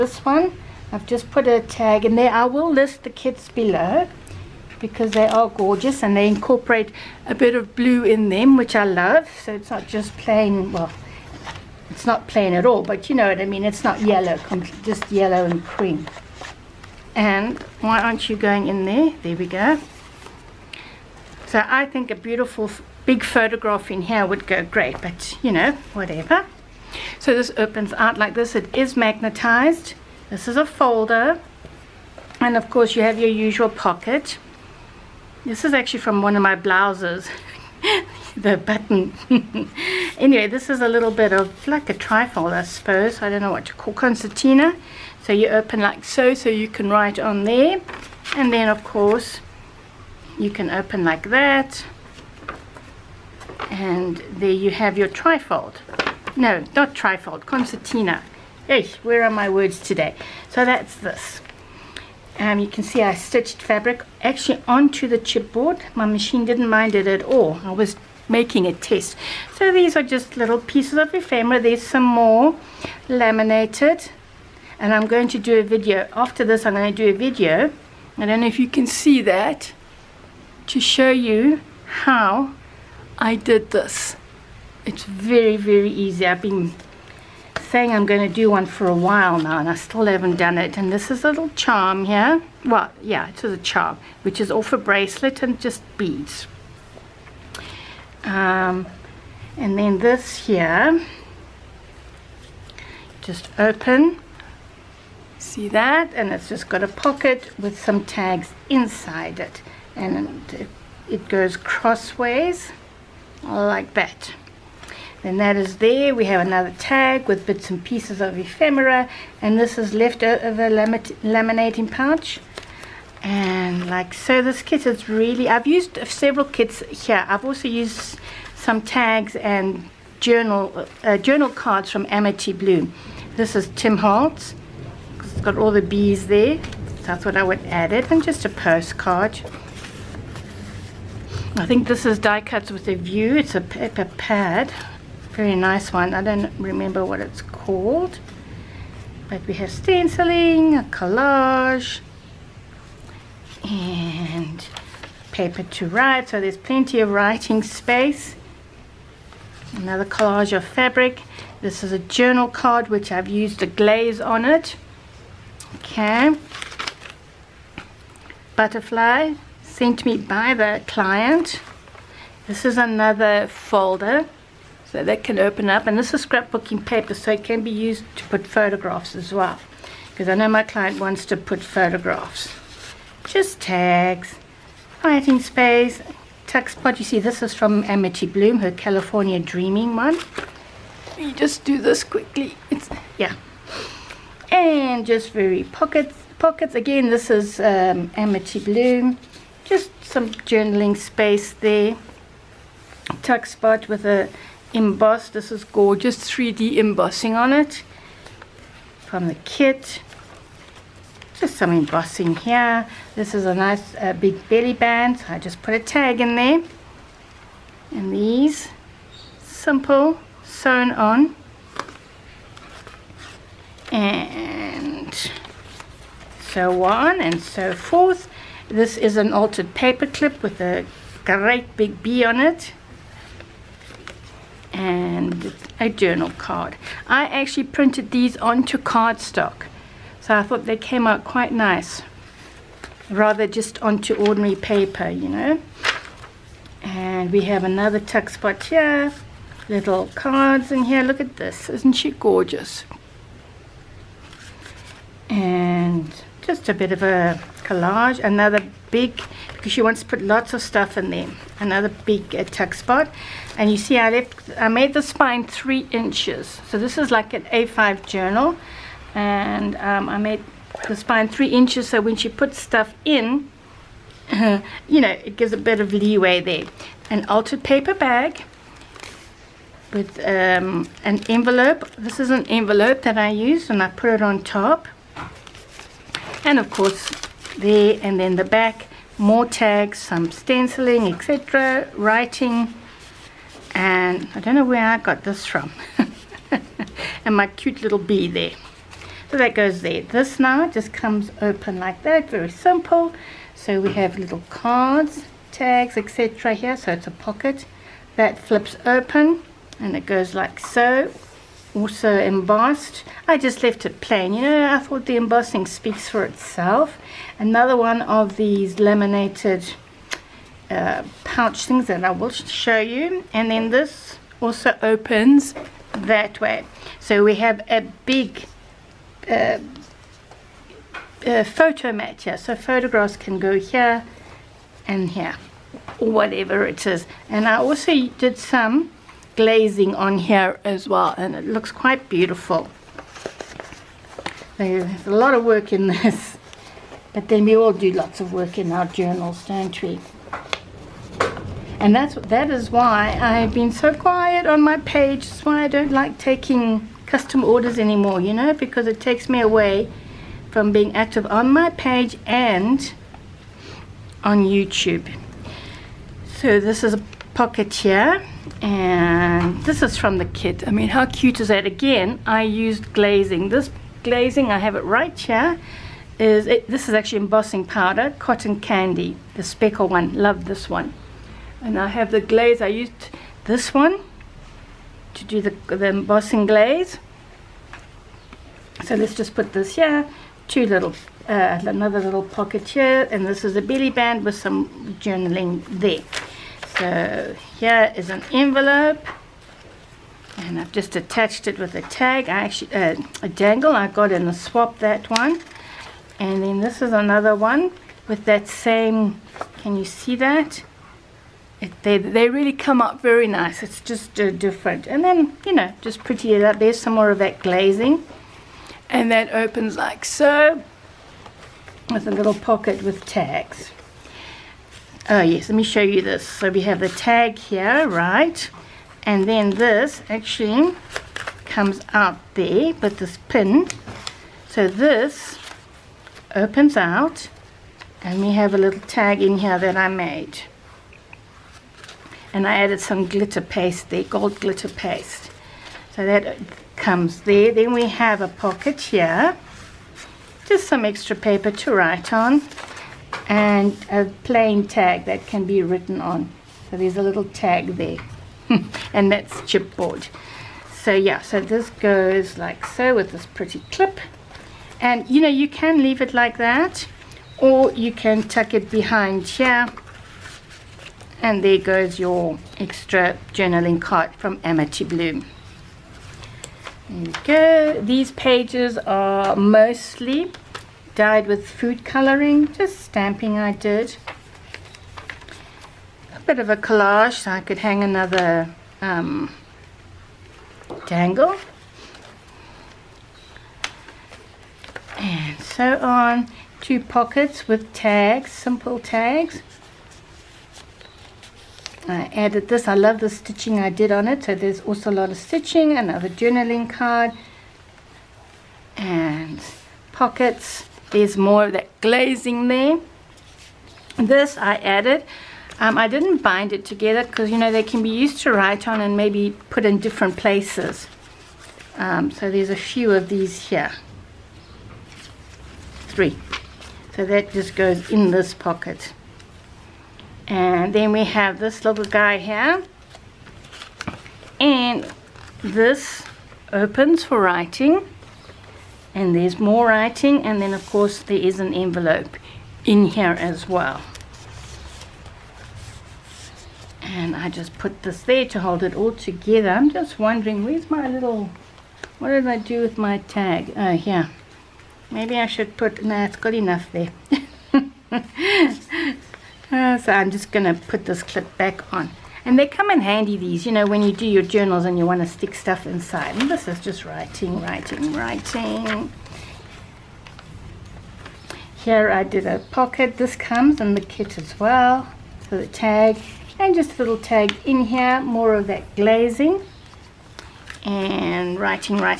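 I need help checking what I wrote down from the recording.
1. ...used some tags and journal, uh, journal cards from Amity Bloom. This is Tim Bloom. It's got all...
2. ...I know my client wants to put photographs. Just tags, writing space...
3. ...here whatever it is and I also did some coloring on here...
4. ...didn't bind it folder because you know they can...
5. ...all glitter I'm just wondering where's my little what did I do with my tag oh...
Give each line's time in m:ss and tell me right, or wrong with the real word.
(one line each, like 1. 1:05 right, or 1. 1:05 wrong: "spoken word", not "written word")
1. 2:07 wrong: "Holtz", not "Bloom"
2. 3:00 right
3. 5:35 wrong: "glazing", not "coloring"
4. 8:35 wrong: "together", not "folder"
5. 9:08 wrong: "together", not "glitter".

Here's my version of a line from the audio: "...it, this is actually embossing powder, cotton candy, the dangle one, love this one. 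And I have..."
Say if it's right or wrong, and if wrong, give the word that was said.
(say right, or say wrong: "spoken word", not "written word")
wrong: "speckle", not "dangle".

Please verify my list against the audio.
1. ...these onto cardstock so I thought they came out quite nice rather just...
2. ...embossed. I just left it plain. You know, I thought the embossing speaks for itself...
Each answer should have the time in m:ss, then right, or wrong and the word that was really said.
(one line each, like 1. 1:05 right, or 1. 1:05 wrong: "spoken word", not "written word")
1. 3:58 right
2. 5:12 right.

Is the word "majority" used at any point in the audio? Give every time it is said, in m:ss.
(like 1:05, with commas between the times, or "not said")
not said.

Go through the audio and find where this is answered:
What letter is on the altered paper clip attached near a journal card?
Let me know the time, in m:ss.
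3:52.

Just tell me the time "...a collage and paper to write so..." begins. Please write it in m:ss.
2:30.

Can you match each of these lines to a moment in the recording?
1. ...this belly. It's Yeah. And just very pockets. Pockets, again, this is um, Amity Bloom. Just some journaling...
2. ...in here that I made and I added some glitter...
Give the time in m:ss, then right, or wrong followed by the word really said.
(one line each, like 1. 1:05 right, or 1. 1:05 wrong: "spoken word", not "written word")
1. 3:11 wrong: "quickly", not "belly"
2. 7:19 right.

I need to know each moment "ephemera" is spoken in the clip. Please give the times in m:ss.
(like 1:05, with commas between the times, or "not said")
1:11, 1:58.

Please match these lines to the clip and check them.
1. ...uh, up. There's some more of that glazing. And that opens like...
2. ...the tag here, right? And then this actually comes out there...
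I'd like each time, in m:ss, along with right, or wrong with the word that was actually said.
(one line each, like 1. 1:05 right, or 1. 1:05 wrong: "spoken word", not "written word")
1. 6:56 right
2. 7:06 right.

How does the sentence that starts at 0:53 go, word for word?
And there you have your trifold no, not trifold, concertina.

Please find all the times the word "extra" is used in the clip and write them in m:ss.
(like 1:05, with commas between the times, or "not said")
7:30, 7:52.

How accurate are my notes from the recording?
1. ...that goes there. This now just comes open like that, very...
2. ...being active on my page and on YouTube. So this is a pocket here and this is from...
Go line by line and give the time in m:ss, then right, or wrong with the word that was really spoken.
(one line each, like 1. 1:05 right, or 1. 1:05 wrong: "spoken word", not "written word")
1. 4:59 right
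2. 6:00 right.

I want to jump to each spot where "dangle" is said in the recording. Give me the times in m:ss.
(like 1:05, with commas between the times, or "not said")
6:43, 8:10.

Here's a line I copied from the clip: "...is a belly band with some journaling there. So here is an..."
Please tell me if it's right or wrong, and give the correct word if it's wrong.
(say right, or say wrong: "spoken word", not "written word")
right.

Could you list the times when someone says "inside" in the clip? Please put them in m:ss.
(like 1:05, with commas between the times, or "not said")
1:48, 9:25.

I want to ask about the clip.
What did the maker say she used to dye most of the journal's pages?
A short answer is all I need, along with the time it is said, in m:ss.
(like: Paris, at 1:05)
food coloring, at 8:01.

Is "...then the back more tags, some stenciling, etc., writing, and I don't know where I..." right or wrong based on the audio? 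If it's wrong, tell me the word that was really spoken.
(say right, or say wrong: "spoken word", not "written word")
right.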